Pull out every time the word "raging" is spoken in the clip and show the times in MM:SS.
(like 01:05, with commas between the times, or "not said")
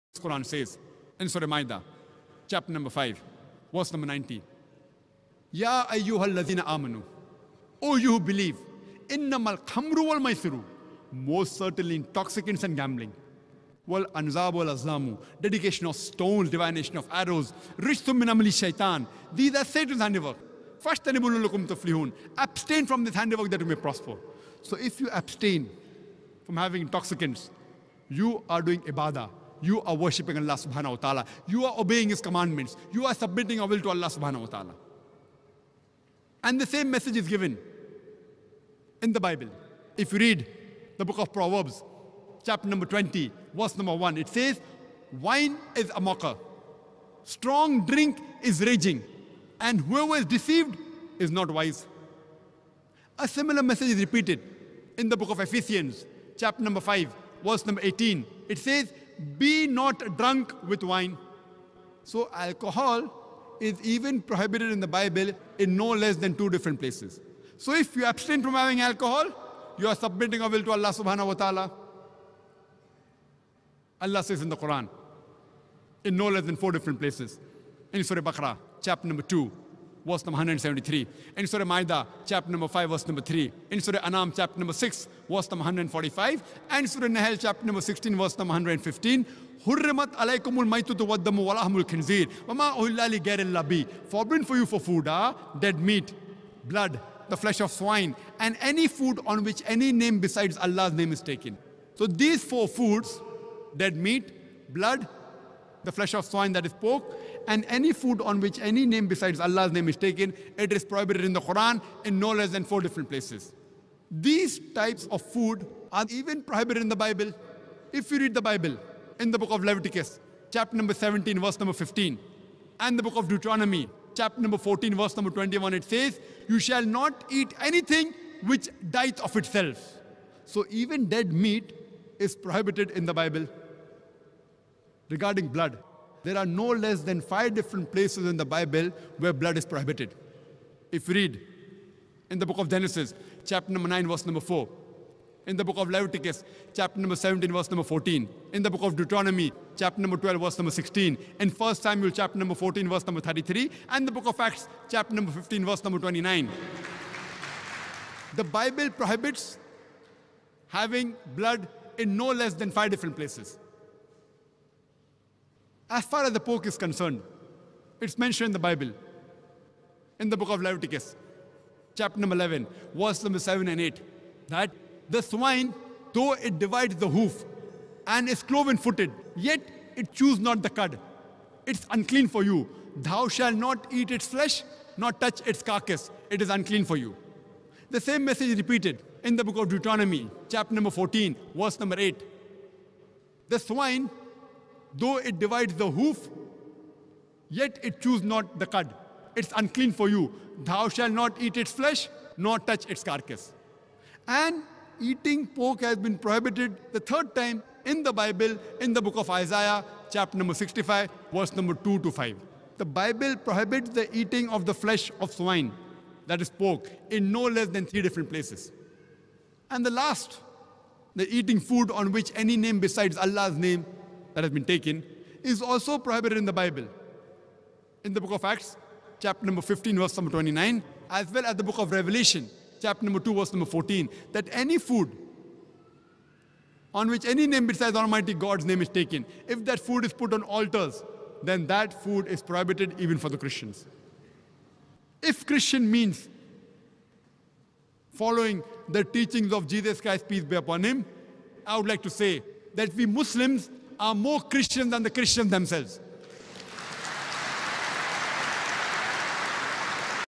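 00:48.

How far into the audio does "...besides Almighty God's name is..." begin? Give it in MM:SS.
03:57.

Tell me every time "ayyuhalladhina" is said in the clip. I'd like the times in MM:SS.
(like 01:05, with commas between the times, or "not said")
00:05.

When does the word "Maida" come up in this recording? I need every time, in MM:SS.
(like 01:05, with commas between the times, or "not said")
00:01, 01:21.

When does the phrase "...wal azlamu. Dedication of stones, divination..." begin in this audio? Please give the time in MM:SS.
00:14.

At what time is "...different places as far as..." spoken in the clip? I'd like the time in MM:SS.
02:42.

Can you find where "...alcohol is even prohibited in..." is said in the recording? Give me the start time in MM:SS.
01:02.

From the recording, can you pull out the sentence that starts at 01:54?
These types of food are even prohibited in the Bible.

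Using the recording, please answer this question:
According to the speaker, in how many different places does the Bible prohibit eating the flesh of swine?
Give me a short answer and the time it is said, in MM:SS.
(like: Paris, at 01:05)
3, at 03:37.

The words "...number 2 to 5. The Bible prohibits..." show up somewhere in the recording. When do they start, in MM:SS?
03:31.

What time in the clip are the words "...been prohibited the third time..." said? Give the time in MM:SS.
03:25.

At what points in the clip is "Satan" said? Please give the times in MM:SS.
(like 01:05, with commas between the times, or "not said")
00:19.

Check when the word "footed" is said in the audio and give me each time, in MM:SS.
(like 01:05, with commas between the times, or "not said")
02:58.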